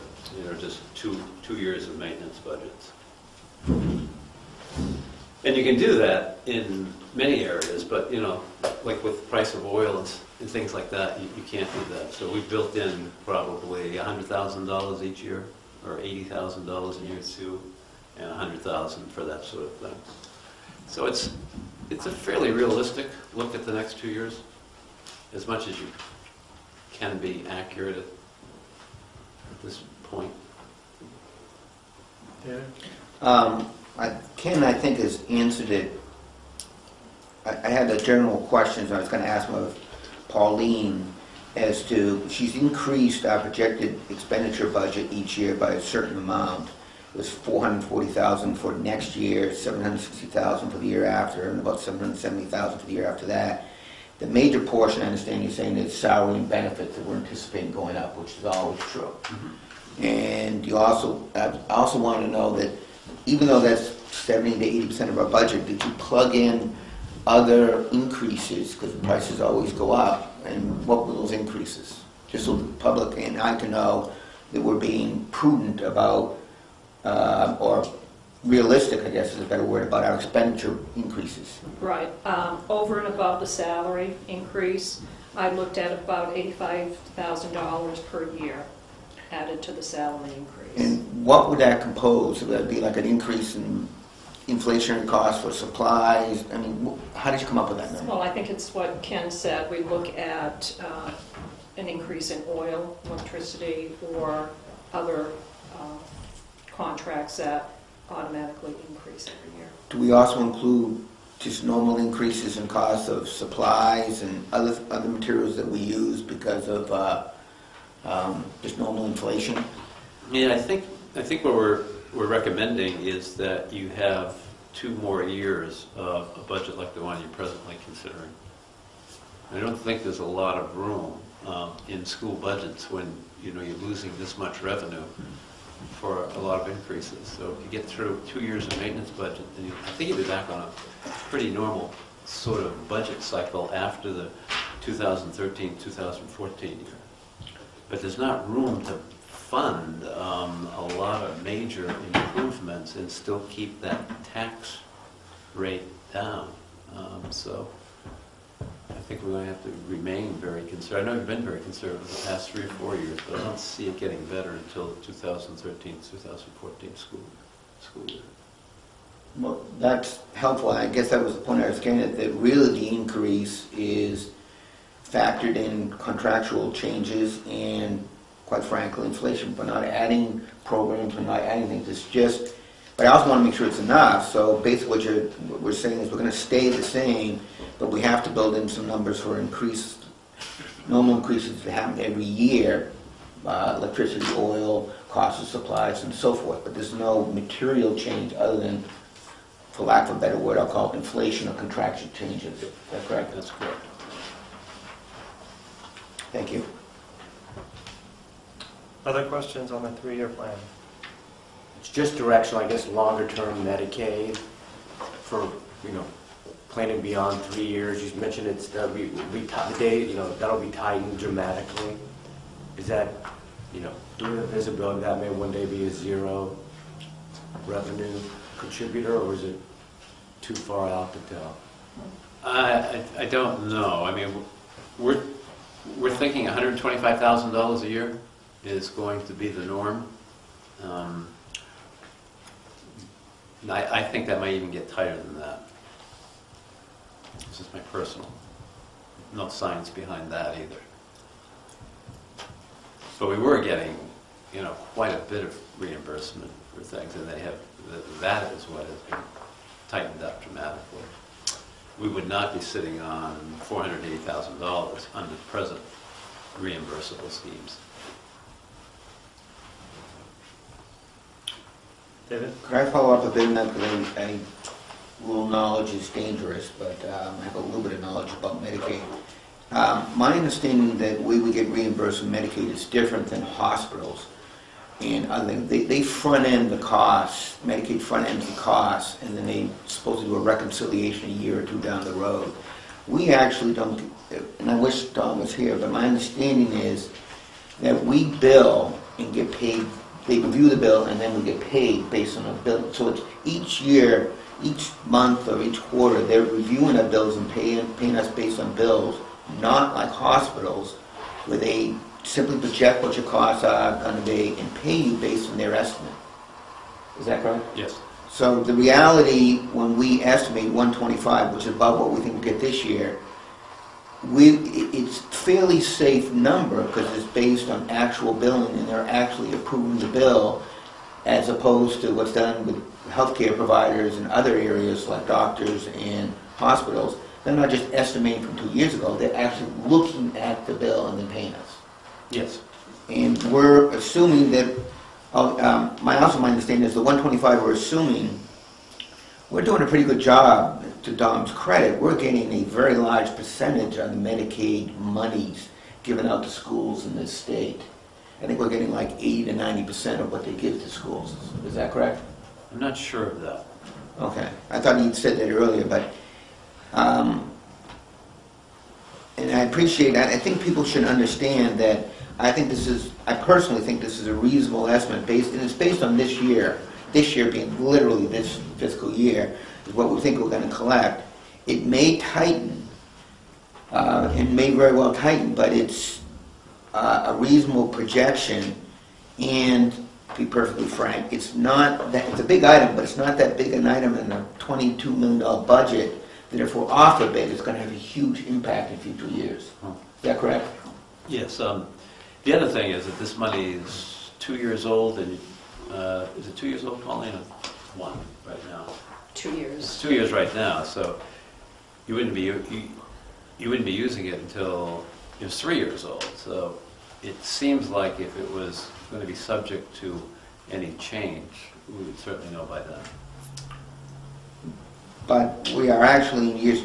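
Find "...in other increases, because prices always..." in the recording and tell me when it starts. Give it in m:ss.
1:06.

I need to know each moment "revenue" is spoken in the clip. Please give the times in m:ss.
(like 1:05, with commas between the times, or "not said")
2:14, 3:47.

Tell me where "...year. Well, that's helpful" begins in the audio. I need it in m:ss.
2:48.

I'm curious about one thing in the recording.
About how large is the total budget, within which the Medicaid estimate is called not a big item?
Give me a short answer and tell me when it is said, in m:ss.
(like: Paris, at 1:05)
$22 million, at 6:34.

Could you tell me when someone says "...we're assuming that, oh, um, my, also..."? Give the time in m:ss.
5:43.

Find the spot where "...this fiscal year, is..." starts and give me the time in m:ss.
6:18.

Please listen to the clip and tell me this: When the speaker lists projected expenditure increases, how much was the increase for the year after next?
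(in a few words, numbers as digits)
$760,000.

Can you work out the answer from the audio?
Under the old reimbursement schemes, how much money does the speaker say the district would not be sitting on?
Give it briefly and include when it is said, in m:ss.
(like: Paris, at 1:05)
$480,000, at 4:23.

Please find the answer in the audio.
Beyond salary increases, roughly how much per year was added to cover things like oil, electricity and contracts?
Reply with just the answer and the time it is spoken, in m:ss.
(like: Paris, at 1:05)
$85,000, at 1:26.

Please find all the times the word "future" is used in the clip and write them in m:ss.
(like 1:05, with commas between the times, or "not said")
6:38.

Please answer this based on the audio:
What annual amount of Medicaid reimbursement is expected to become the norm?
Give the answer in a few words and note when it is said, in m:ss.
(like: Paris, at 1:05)
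$125,000, at 3:56.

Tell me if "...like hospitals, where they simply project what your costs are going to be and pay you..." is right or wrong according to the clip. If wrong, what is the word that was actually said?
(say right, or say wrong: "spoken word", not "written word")
right.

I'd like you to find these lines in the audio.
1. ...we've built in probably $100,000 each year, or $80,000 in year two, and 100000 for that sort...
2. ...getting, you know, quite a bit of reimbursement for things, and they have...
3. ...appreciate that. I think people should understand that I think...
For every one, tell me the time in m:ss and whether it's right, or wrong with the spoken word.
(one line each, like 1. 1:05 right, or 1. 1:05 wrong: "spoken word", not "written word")
1. 0:12 right
2. 4:13 right
3. 6:09 right.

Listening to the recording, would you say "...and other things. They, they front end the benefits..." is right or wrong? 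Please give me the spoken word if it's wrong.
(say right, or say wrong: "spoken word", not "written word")
wrong: "costs", not "benefits".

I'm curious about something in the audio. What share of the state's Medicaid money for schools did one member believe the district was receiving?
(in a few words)
80 to 90%.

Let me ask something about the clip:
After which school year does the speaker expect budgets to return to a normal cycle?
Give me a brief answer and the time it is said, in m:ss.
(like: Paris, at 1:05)
2013-2014, at 2:24.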